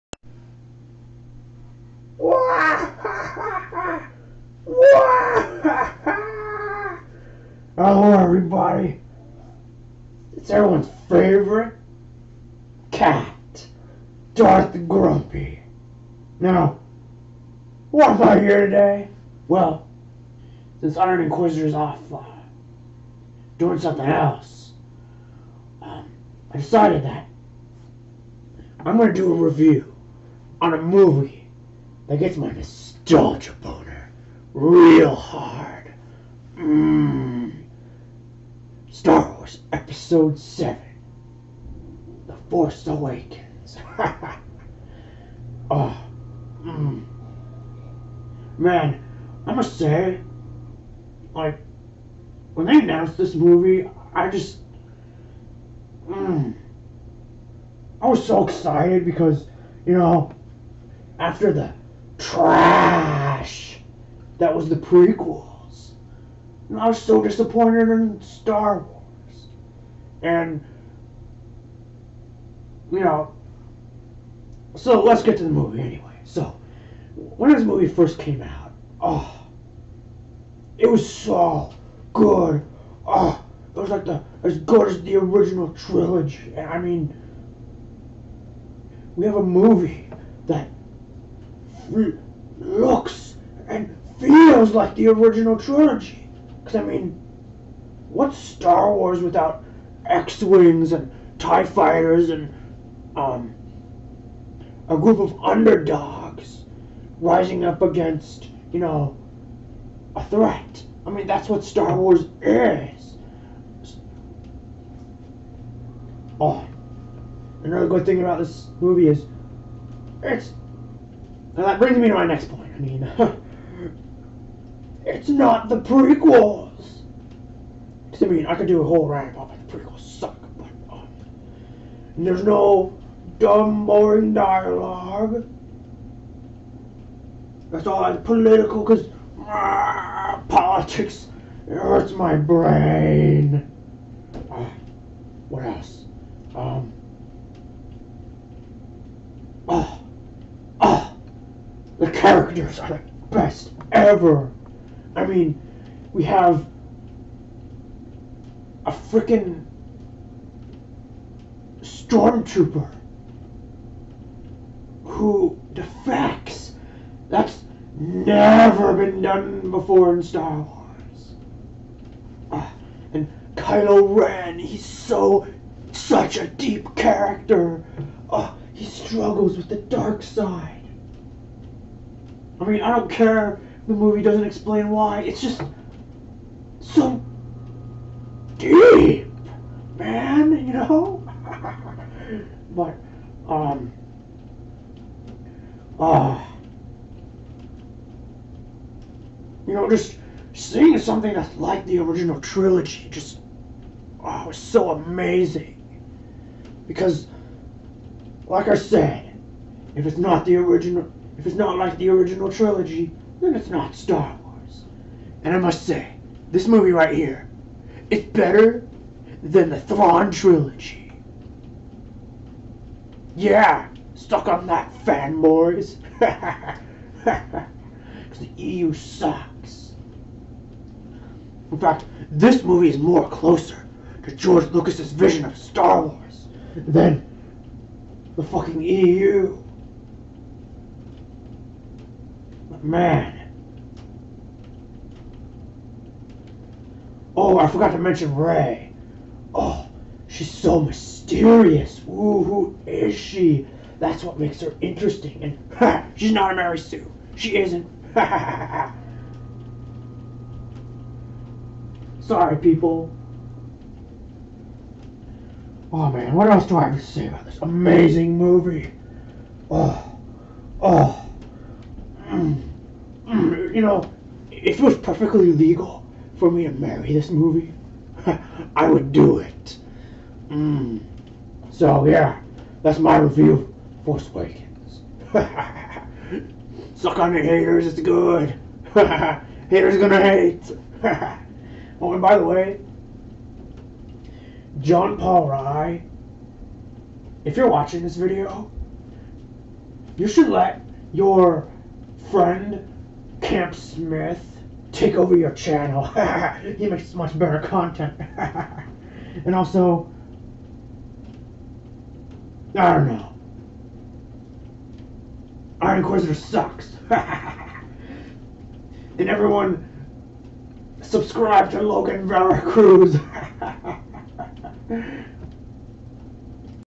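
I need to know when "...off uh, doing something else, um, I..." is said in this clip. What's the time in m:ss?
0:21.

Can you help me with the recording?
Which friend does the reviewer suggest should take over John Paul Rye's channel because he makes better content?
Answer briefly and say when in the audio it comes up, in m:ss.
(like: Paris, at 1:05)
Camp Smith, at 5:03.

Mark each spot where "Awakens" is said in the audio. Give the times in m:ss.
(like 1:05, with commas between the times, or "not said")
0:42, 4:44.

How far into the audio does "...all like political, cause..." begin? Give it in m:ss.
2:17.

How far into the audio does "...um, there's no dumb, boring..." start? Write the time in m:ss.
2:10.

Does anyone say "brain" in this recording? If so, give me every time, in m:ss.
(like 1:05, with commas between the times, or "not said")
2:22.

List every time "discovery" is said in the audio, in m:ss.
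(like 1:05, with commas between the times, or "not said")
not said.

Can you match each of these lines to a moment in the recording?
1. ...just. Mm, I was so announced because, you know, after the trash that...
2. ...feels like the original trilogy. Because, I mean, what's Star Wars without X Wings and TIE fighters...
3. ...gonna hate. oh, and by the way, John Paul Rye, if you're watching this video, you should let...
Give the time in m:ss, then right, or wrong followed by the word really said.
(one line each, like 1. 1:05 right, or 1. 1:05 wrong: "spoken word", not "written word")
1. 0:54 wrong: "excited", not "announced"
2. 1:34 right
3. 4:49 right.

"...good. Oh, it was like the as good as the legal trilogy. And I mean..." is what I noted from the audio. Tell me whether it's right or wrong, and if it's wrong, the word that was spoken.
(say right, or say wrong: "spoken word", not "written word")
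wrong: "original", not "legal".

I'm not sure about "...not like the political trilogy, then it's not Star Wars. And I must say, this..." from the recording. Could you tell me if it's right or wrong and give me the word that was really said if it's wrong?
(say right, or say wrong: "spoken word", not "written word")
wrong: "original", not "political".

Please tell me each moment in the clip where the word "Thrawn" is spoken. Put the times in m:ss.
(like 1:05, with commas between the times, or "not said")
3:39.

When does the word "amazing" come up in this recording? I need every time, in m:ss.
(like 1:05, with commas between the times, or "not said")
3:24, 4:27.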